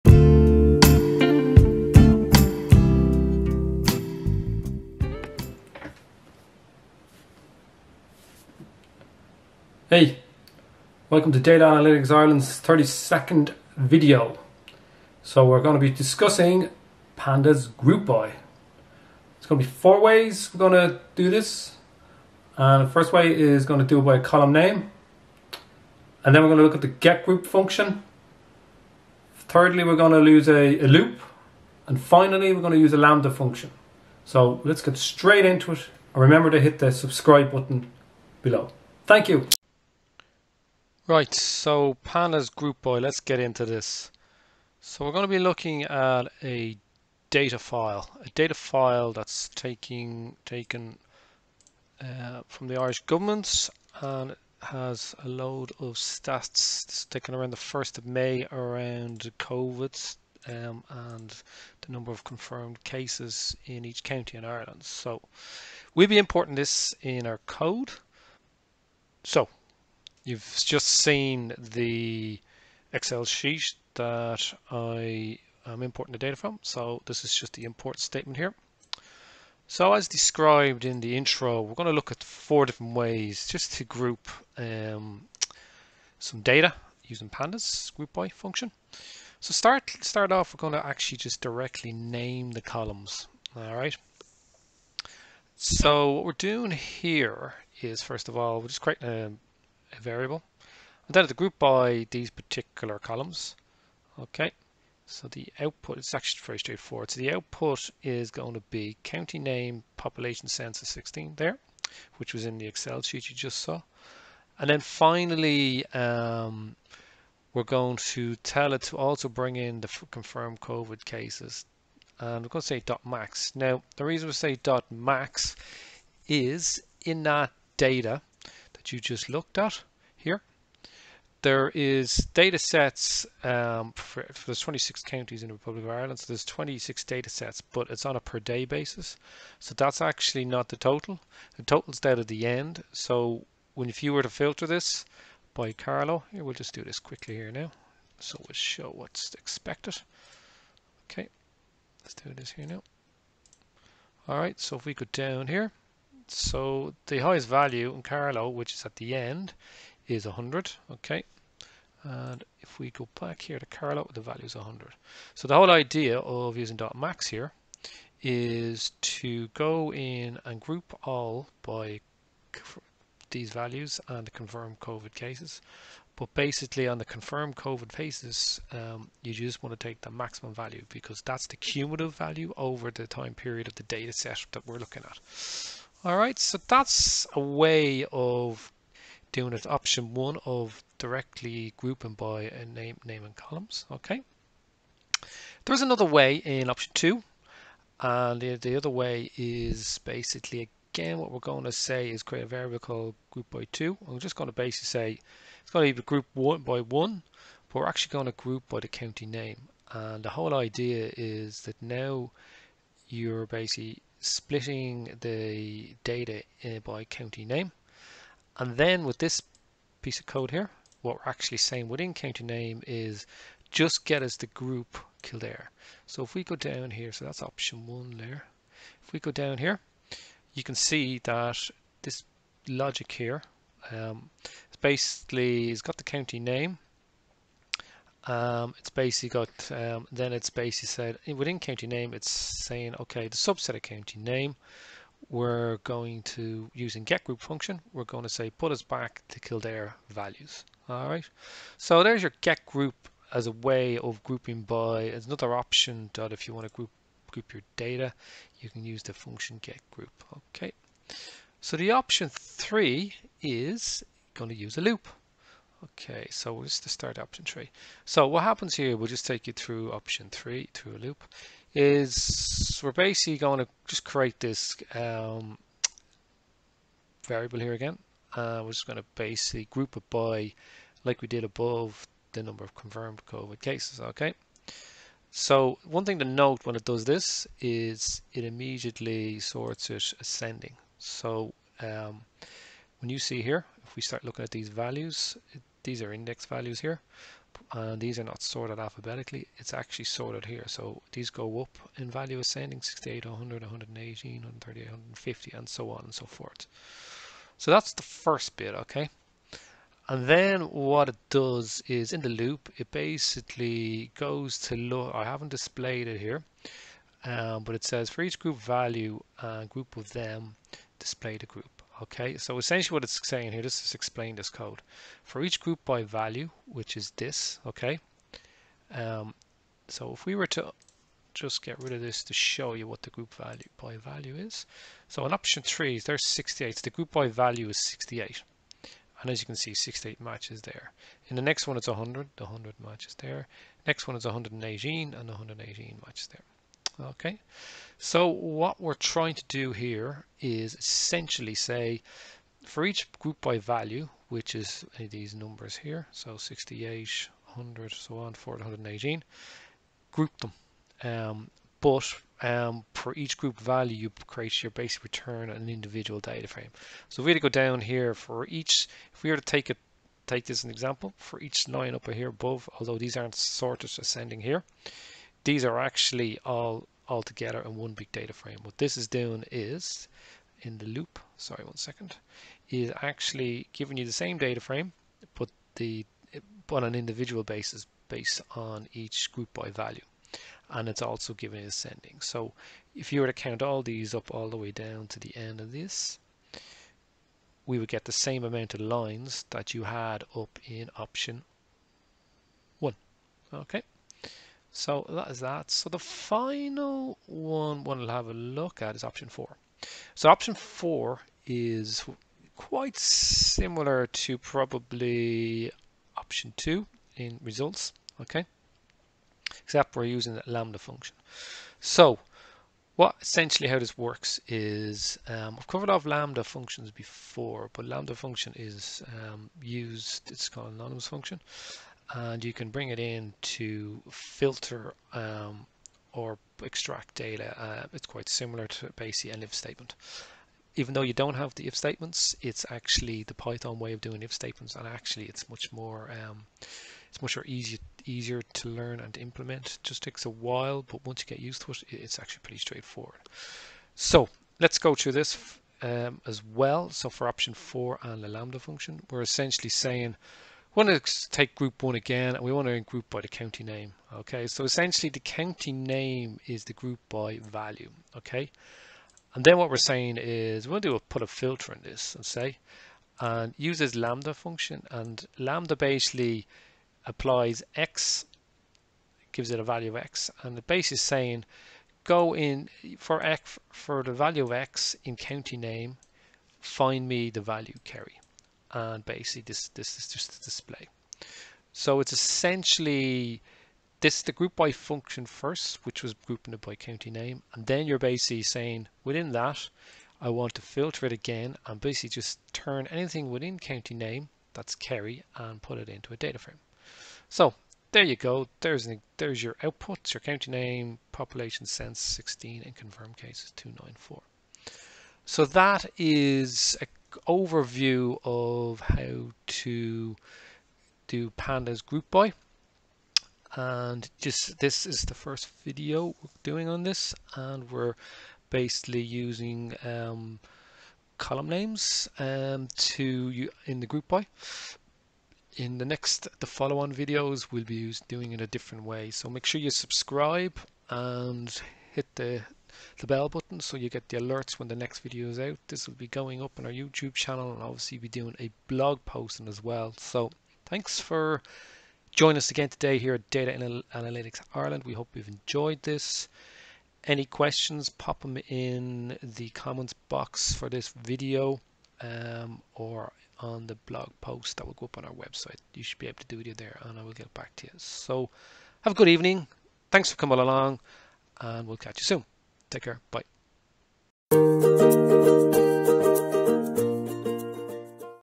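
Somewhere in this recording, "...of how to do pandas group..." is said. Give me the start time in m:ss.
8:38.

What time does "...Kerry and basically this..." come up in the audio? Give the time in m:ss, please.
8:07.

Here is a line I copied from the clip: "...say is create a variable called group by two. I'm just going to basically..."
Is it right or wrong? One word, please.
right.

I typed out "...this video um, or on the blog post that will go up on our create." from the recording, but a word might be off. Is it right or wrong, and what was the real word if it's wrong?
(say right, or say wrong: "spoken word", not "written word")
wrong: "website", not "create".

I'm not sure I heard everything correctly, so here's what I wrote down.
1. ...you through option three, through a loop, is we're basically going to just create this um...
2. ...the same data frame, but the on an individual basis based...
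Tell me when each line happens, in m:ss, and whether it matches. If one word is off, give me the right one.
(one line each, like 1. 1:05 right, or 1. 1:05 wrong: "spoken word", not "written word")
1. 4:29 right
2. 6:24 right.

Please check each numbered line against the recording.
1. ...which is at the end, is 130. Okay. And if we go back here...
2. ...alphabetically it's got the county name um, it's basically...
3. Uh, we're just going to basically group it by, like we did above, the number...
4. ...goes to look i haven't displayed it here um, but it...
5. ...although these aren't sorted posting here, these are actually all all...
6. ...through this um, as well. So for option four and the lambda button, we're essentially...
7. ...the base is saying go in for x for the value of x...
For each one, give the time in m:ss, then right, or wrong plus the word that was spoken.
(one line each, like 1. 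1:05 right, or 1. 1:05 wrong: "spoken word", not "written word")
1. 2:38 wrong: "100", not "130"
2. 3:54 wrong: "basically", not "alphabetically"
3. 4:38 right
4. 5:14 right
5. 6:12 wrong: "ascending", not "posting"
6. 7:34 wrong: "function", not "button"
7. 8:00 right.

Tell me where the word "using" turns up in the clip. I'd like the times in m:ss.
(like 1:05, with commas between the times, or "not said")
1:27, 2:46, 4:06, 7:00, 8:49.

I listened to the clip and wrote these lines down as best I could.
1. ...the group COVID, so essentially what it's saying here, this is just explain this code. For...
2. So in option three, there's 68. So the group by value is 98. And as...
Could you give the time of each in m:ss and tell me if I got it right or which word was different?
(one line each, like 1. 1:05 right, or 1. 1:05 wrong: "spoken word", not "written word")
1. 5:21 wrong: "Okay", not "COVID"
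2. 5:35 wrong: "68", not "98".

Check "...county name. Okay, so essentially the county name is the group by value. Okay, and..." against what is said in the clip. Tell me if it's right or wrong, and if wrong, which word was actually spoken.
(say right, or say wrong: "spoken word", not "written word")
right.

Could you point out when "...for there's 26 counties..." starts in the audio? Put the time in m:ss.
2:14.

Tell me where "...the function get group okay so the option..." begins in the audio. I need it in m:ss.
4:19.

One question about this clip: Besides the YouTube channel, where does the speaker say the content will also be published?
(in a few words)
blog posting.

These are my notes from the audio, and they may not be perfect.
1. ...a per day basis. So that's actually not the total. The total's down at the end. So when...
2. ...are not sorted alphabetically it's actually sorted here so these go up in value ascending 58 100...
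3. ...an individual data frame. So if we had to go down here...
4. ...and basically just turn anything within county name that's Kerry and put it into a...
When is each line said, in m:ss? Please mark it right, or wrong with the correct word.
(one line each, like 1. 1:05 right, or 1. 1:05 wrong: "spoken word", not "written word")
1. 2:18 right
2. 4:58 wrong: "68", not "58"
3. 6:05 right
4. 8:21 right.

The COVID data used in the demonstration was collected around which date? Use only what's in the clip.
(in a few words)
1st of May.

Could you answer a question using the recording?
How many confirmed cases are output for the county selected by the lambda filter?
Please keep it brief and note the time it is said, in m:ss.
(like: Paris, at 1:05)
294, at 8:33.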